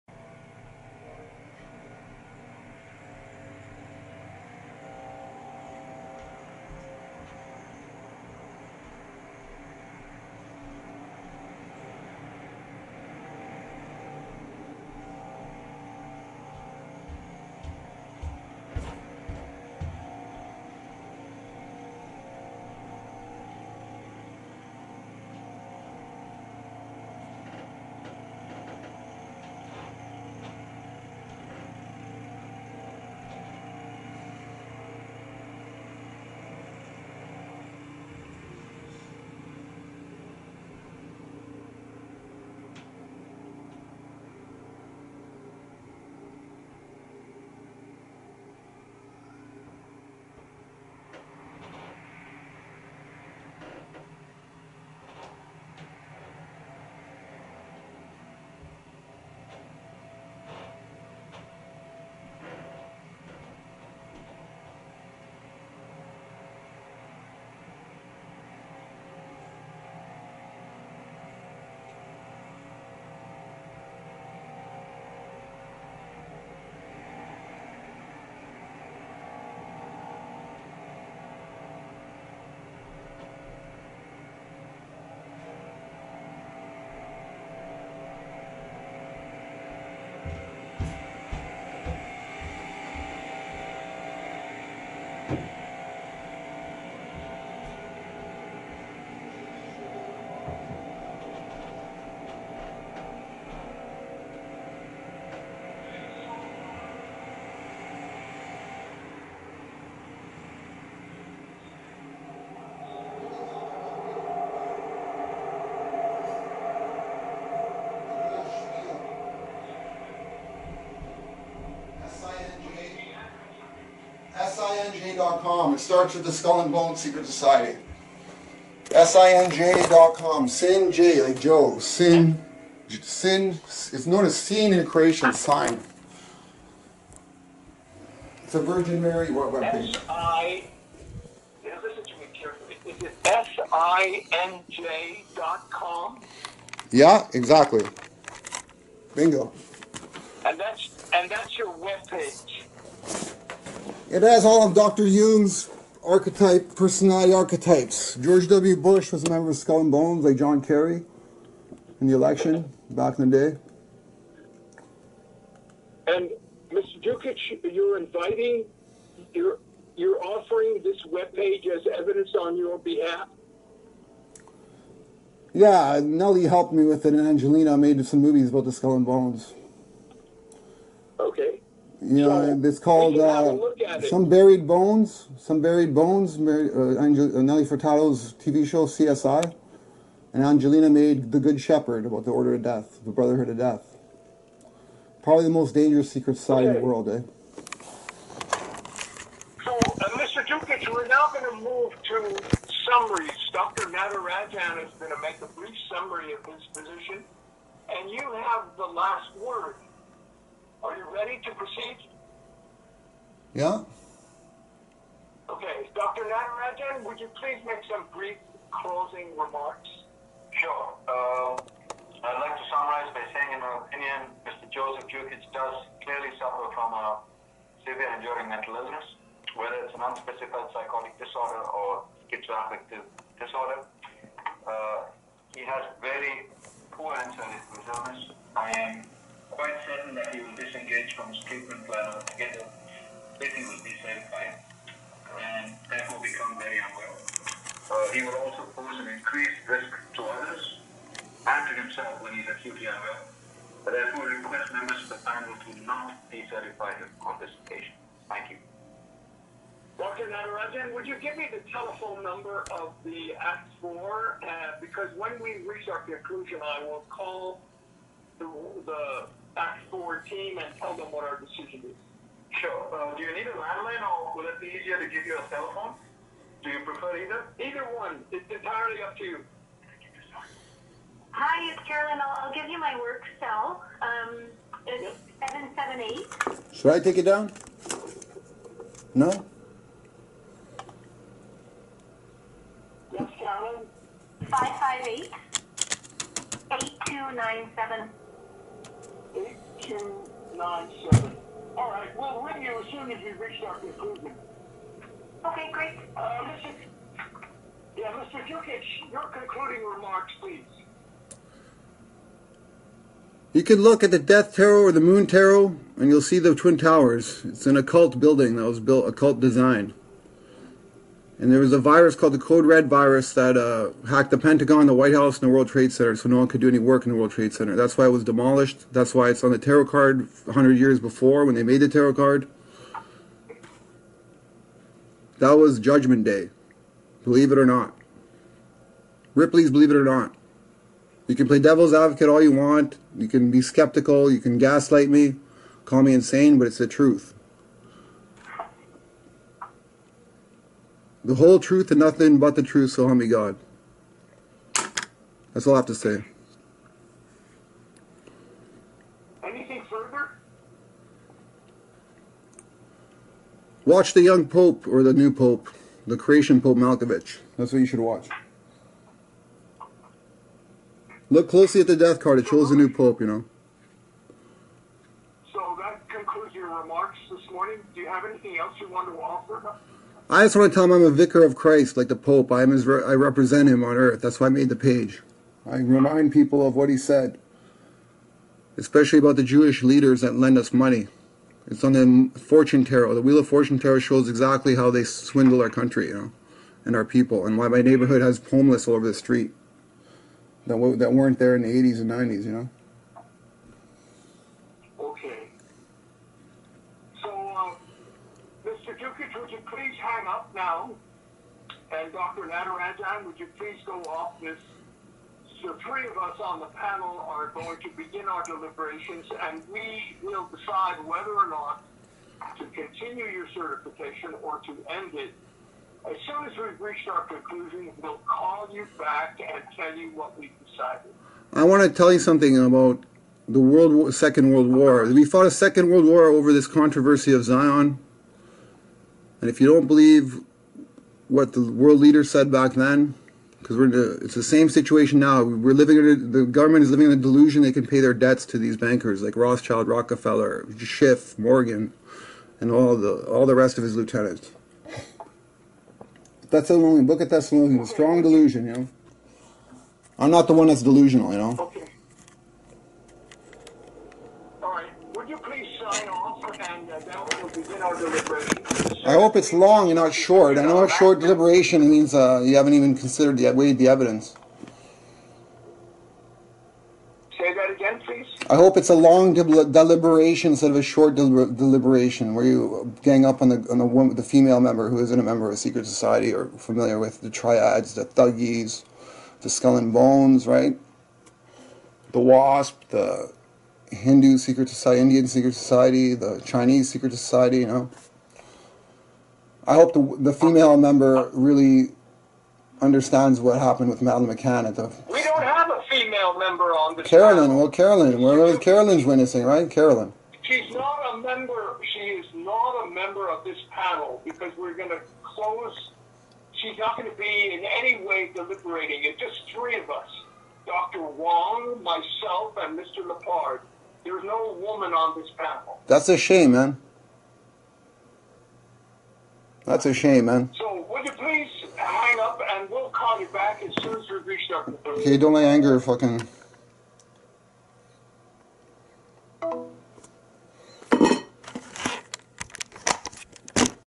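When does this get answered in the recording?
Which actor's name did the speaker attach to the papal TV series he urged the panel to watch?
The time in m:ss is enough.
6:06.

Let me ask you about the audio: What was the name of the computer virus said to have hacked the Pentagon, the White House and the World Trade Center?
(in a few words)
Code Red.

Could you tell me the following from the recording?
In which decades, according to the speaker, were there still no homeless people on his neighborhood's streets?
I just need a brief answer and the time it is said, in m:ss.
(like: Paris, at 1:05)
80s and 90s, at 6:41.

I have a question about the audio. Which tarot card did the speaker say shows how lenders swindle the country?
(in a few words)
Wheel of Fortune.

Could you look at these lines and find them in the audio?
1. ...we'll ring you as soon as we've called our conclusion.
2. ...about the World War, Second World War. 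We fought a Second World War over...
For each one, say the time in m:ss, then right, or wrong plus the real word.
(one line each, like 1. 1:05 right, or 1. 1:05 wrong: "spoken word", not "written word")
1. 5:02 wrong: "reached", not "called"
2. 7:12 right.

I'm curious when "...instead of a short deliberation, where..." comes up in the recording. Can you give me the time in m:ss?
8:00.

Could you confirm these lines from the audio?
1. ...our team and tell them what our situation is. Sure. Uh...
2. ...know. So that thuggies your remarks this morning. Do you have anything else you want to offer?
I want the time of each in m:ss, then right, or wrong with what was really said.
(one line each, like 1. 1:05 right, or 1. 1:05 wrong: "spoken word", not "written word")
1. 4:30 wrong: "decision", not "situation"
2. 6:13 wrong: "concludes", not "thuggies".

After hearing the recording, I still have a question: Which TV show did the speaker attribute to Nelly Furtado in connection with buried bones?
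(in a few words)
CSI.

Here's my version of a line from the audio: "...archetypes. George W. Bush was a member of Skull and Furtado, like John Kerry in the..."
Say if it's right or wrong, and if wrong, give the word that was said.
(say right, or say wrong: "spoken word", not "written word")
wrong: "Bones", not "Furtado".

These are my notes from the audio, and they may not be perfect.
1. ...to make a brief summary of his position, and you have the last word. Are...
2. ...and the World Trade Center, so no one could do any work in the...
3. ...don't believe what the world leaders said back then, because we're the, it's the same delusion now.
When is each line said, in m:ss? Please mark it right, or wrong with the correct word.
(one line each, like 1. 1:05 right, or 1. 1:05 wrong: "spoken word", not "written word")
1. 3:25 right
2. 5:25 right
3. 7:19 wrong: "situation", not "delusion".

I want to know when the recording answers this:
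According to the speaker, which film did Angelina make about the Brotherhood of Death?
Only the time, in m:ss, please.
3:11.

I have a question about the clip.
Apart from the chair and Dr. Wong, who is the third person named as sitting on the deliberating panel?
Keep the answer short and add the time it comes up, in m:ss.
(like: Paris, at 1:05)
Mr. Lepard, at 8:42.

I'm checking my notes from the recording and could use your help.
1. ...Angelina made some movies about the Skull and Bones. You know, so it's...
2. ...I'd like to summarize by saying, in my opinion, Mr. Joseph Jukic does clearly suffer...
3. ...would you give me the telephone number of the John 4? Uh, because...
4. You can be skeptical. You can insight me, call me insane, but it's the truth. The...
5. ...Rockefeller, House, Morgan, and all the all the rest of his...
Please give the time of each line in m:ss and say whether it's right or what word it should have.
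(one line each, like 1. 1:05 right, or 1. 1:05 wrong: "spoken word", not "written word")
1. 2:57 right
2. 3:42 right
3. 4:20 wrong: "Act", not "John"
4. 5:43 wrong: "gaslight", not "insight"
5. 7:29 wrong: "Schiff", not "House".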